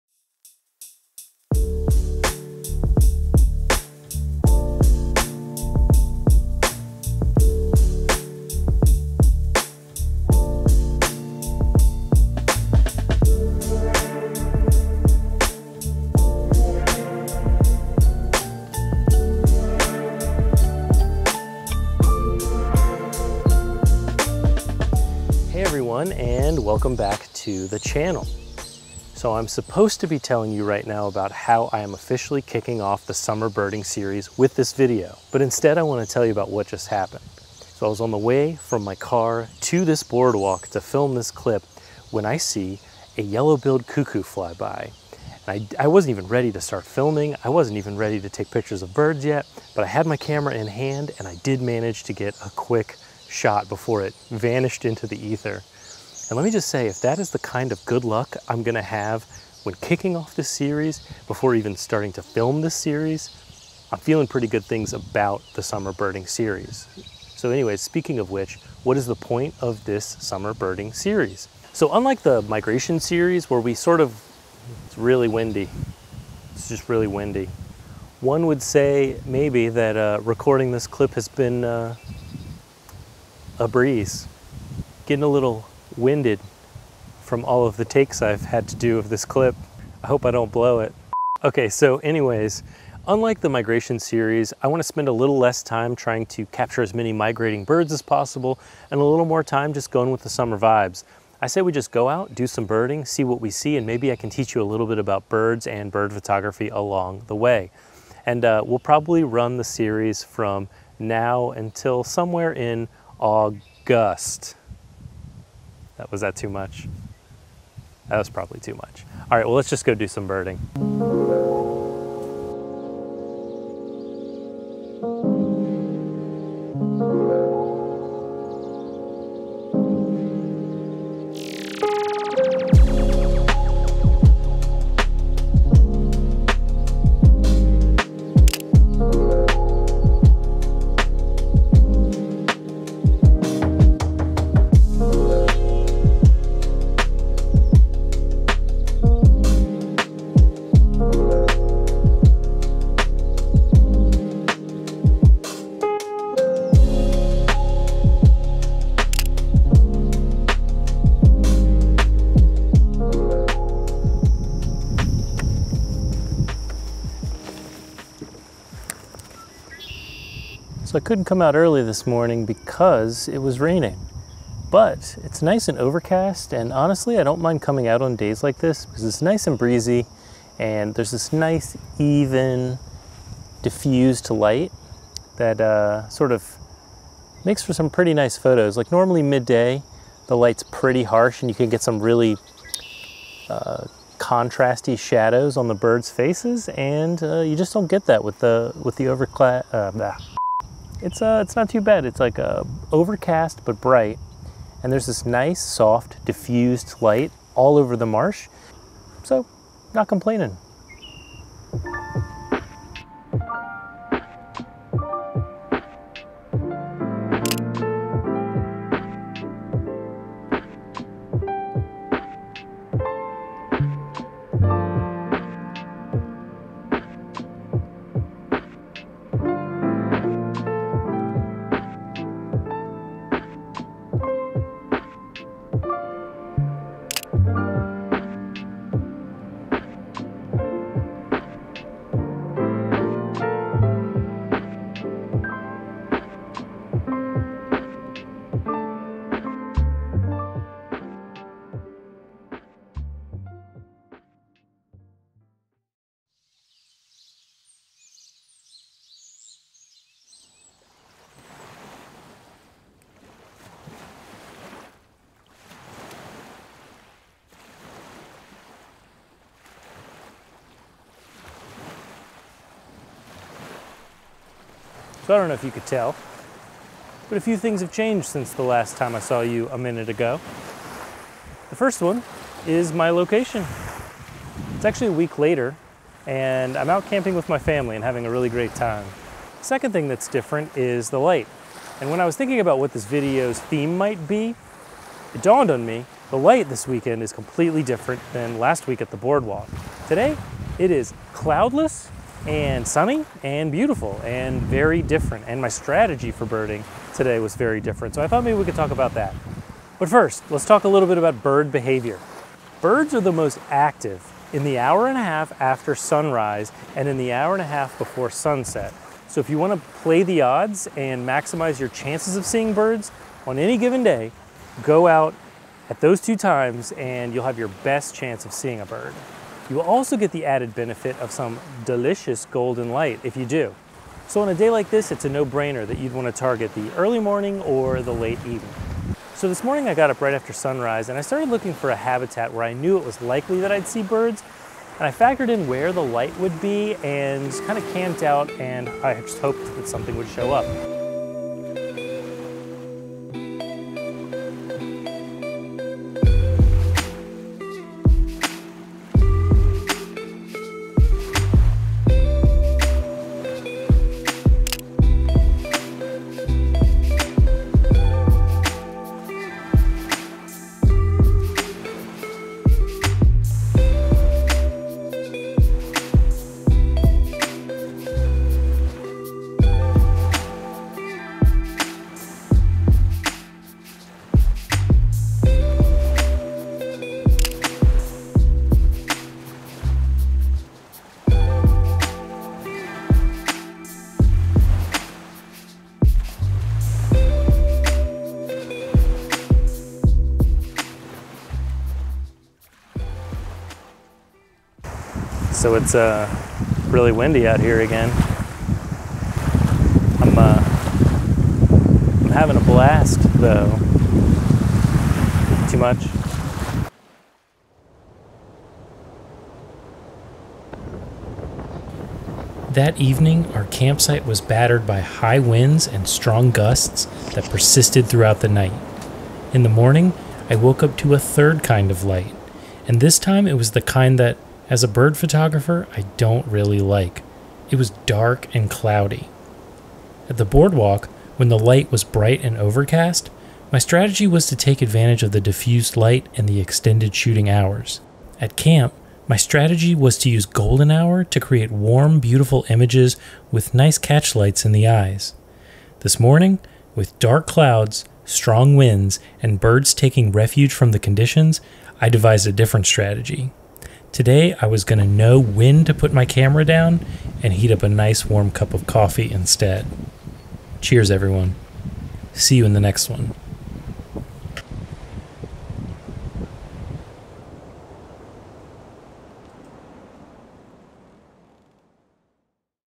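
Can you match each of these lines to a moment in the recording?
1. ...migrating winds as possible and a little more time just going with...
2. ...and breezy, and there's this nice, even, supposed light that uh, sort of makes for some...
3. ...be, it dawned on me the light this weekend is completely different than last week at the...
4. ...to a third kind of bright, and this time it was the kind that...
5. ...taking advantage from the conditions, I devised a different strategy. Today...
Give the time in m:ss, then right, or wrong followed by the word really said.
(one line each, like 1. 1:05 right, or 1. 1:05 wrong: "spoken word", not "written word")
1. 1:37 wrong: "birds", not "winds"
2. 2:59 wrong: "diffused", not "supposed"
3. 4:54 right
4. 7:10 wrong: "light", not "bright"
5. 7:39 wrong: "refuge", not "advantage".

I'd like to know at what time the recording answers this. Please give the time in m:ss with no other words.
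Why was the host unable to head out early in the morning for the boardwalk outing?
2:53.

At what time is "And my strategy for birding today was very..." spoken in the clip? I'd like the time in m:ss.
5:05.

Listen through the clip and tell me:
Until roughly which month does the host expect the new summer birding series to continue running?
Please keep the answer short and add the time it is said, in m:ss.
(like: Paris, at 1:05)
August, at 1:53.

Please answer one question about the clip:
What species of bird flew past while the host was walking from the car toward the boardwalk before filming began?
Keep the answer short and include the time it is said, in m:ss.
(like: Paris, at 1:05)
Yellow-billed cuckoo, at 0:43.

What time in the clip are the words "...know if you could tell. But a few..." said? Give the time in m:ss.
4:35.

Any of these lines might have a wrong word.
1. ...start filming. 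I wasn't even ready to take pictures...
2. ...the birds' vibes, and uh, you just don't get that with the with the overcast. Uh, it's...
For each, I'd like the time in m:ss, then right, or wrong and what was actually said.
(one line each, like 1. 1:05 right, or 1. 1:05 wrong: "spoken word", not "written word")
1. 0:46 right
2. 3:15 wrong: "faces", not "vibes".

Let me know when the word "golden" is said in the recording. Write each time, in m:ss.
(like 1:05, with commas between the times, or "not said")
5:32, 7:30.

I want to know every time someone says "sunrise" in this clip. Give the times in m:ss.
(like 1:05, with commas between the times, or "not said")
5:15, 5:40.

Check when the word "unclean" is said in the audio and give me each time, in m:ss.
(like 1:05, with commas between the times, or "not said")
not said.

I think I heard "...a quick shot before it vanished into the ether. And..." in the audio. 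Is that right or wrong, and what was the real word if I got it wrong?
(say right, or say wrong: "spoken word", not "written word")
right.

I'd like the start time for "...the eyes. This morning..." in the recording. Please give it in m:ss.
7:34.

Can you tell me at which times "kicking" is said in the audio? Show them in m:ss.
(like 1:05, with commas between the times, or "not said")
0:32, 0:59.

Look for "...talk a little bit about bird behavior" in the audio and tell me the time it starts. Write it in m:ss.
5:10.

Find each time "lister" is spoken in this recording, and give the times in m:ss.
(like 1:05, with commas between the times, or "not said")
not said.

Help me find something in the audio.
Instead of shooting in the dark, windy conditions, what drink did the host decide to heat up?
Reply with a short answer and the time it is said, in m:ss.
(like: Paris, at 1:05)
Coffee, at 7:48.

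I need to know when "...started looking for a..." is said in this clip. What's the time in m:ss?
5:41.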